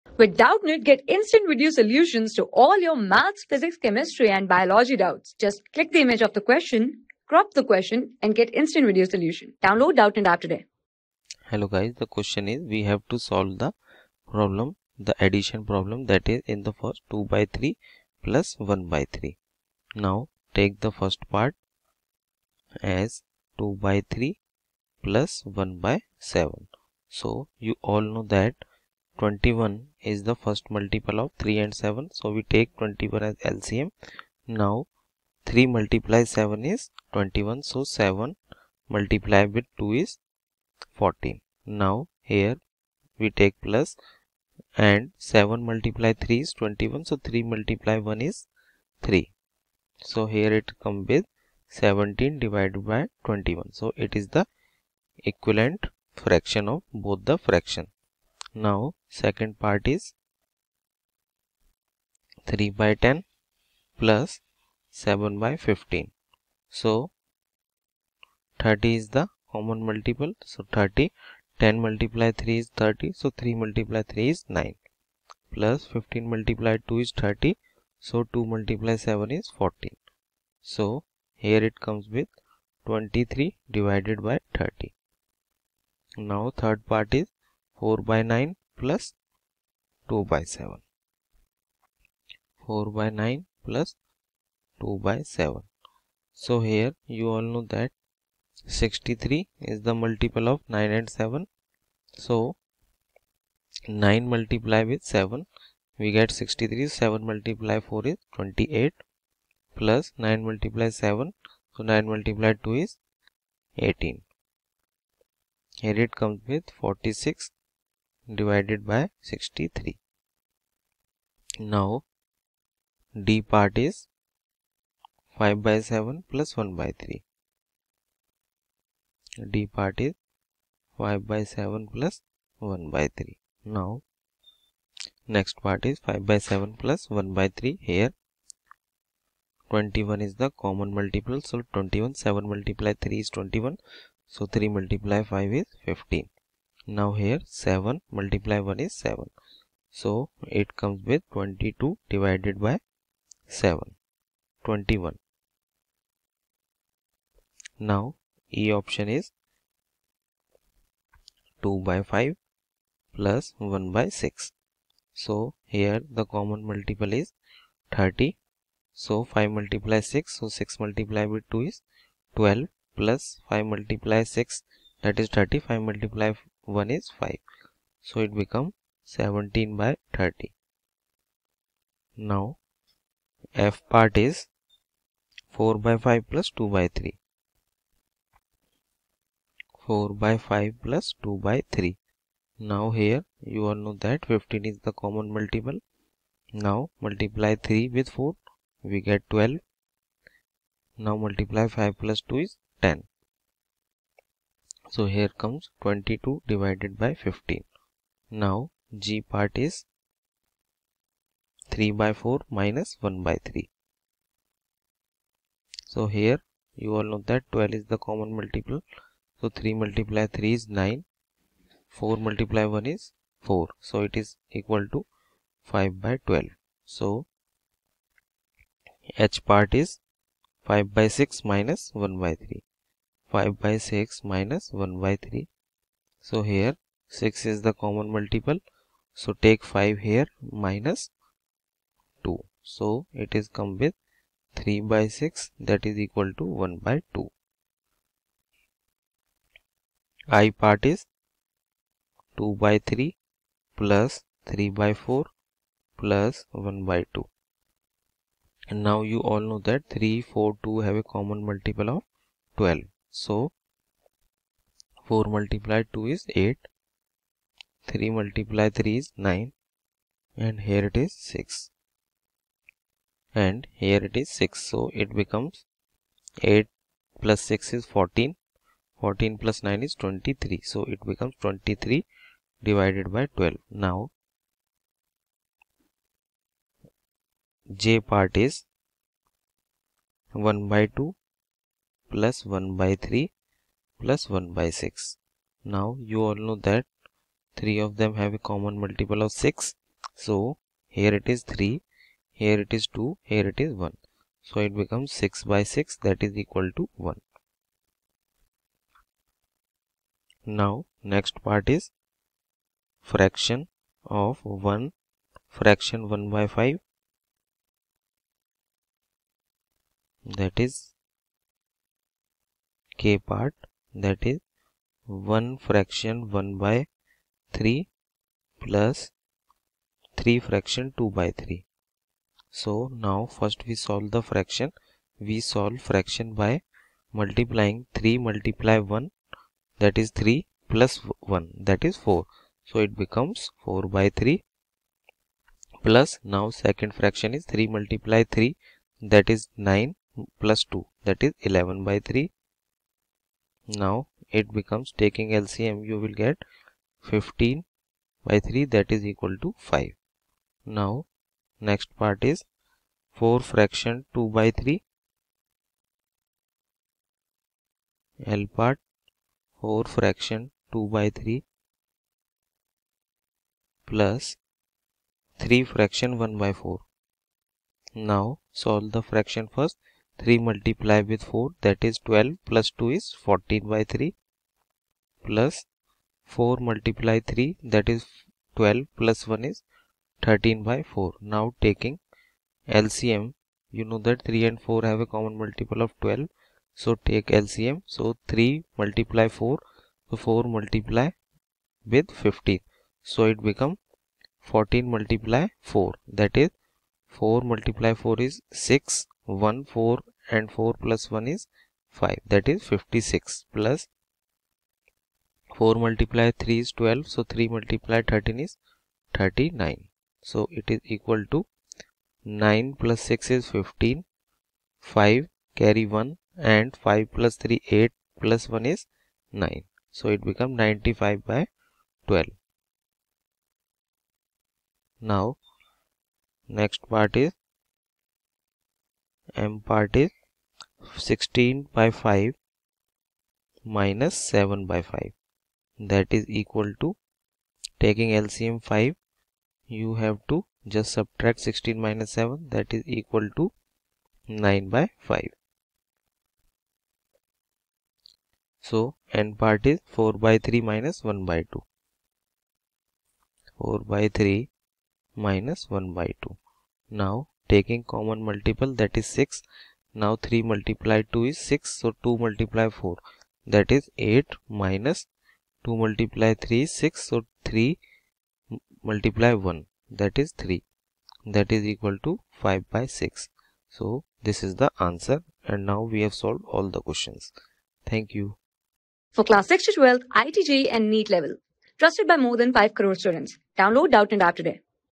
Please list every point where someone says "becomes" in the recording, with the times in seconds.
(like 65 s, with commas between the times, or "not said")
178 s, 275 s, 281 s, 304 s, 342 s, 354 s, 403 s, 430 s.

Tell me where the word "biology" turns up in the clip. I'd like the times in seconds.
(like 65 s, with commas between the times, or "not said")
4 s.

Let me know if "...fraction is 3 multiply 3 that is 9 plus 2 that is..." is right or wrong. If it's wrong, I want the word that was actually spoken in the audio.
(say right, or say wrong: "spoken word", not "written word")
right.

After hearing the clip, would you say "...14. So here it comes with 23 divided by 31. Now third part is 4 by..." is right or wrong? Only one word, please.
wrong.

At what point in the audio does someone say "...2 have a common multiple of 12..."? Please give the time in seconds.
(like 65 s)
260 s.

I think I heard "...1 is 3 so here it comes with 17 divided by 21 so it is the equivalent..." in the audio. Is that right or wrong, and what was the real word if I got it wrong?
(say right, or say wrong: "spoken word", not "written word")
right.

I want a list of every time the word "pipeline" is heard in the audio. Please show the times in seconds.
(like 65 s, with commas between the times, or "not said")
not said.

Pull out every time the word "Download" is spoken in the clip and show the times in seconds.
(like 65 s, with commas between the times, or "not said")
9 s, 493 s.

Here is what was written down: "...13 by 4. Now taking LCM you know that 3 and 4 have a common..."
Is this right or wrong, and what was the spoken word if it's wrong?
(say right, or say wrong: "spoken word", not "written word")
right.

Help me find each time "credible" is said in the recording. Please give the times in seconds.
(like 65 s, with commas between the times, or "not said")
not said.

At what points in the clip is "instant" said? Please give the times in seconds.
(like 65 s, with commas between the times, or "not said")
1 s, 8 s.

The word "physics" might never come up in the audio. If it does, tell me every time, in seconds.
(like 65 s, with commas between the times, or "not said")
3 s.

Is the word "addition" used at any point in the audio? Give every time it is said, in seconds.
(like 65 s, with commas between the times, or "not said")
15 s.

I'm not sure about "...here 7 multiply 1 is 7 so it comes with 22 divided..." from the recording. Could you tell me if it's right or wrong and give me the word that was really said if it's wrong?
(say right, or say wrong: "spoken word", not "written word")
right.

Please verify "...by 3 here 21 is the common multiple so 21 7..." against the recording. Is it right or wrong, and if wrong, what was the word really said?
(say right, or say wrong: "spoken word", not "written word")
right.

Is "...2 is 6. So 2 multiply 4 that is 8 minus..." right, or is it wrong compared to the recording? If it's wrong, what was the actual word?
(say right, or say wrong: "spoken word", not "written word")
right.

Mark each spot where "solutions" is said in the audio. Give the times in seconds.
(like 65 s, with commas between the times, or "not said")
1 s, 9 s.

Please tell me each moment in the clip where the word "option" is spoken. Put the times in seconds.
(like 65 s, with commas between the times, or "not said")
158 s.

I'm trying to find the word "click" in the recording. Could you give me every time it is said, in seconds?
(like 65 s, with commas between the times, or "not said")
5 s.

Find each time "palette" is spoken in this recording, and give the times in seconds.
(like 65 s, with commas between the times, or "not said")
not said.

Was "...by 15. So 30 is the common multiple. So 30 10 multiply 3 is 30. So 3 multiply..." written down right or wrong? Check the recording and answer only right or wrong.
right.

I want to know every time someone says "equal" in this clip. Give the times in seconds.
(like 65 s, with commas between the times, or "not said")
224 s, 246 s, 306 s, 359 s, 420 s, 446 s, 452 s, 481 s.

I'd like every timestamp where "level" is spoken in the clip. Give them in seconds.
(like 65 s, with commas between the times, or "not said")
491 s.